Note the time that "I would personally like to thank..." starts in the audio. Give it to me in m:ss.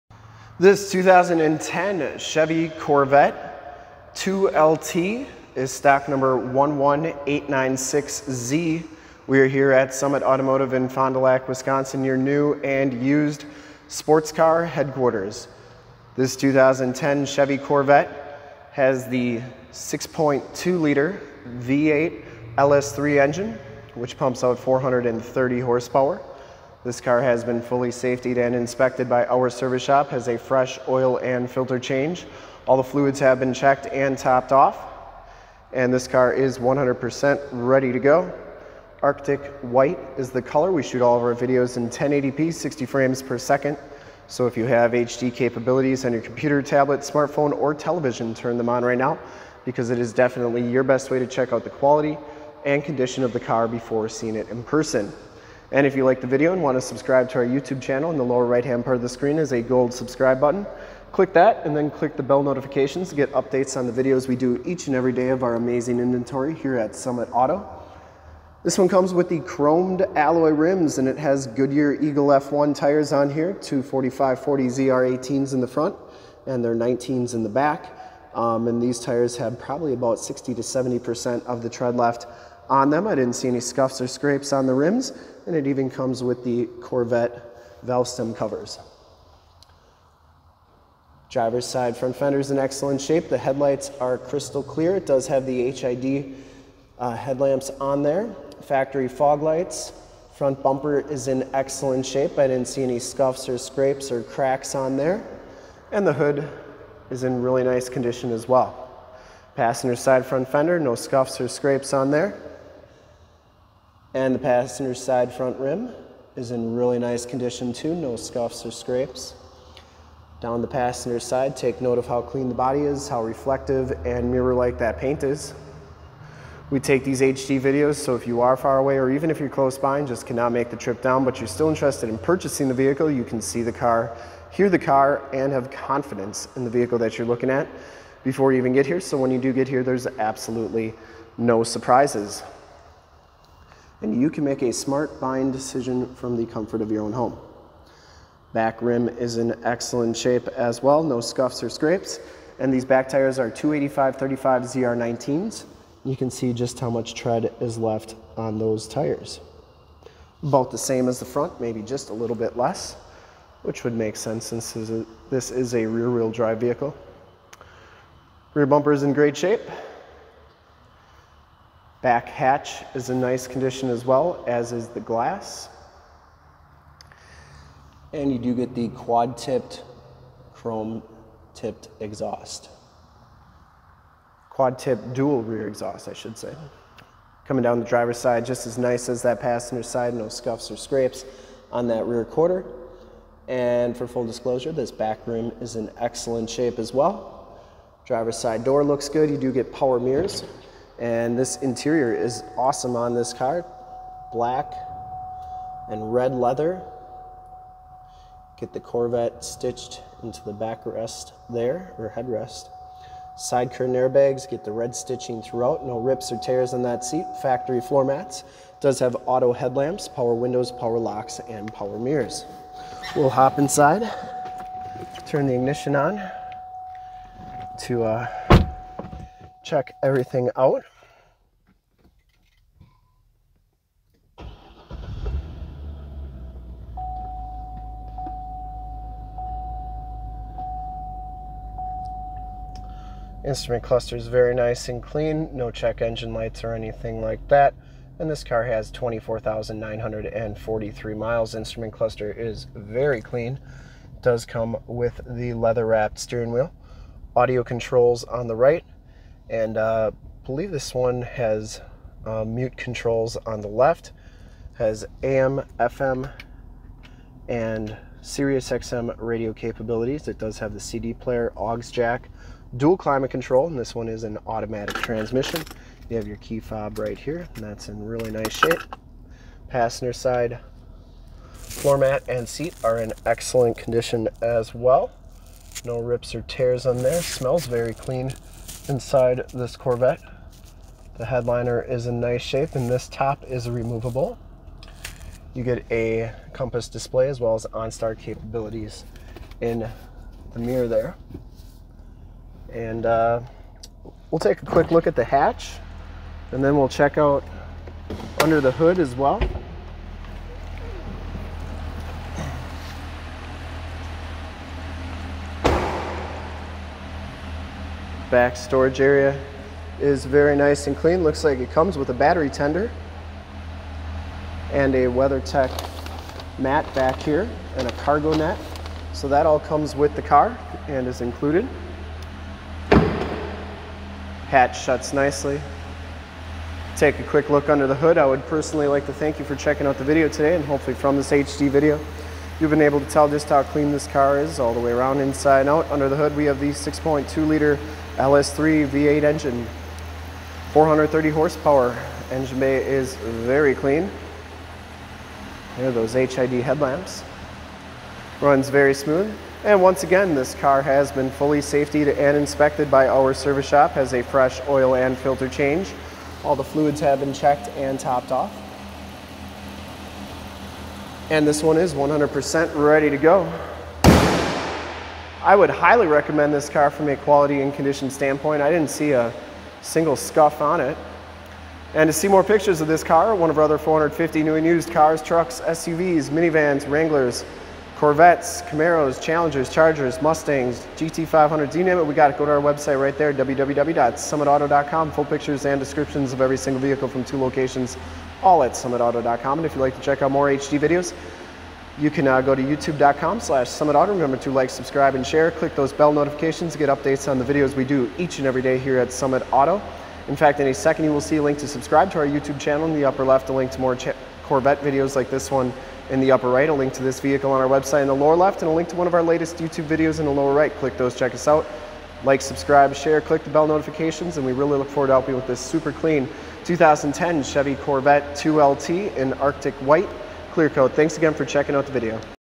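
5:38.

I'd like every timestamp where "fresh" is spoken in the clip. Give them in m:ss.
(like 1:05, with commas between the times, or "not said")
0:30, 6:04.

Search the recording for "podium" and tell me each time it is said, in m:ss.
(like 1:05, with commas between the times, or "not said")
not said.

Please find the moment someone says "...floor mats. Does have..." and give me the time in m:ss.
3:37.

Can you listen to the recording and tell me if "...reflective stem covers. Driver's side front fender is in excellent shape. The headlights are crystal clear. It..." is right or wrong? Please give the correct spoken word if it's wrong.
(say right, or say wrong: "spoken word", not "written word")
wrong: "valve", not "reflective".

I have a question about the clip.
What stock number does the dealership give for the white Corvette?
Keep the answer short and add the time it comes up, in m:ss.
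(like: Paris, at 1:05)
11896Z, at 0:06.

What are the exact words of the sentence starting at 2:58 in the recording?
And you do get the quad tipped, chrome tipped exhaust.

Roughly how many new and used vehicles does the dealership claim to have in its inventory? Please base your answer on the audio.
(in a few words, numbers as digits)
450.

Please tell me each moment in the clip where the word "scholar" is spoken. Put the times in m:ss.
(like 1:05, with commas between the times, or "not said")
not said.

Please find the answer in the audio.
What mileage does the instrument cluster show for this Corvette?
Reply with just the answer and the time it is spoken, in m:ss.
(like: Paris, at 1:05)
24,943 miles, at 4:08.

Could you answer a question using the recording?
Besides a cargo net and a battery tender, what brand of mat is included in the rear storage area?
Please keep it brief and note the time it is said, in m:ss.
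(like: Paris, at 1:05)
WeatherTech, at 5:25.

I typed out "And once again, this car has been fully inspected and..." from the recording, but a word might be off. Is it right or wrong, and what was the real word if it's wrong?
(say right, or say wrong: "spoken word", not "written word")
wrong: "safetied", not "inspected".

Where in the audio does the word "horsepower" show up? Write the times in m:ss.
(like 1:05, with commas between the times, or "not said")
0:25, 5:51.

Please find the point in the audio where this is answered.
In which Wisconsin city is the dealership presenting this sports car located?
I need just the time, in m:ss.
0:10.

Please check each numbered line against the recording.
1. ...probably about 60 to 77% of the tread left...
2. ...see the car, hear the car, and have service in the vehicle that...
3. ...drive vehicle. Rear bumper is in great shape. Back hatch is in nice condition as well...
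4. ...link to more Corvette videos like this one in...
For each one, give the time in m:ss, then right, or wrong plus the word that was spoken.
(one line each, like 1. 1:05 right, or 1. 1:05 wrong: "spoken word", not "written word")
1. 1:19 wrong: "70", not "77"
2. 2:13 wrong: "confidence", not "service"
3. 2:46 right
4. 6:53 right.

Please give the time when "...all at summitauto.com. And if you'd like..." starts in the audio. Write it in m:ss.
6:38.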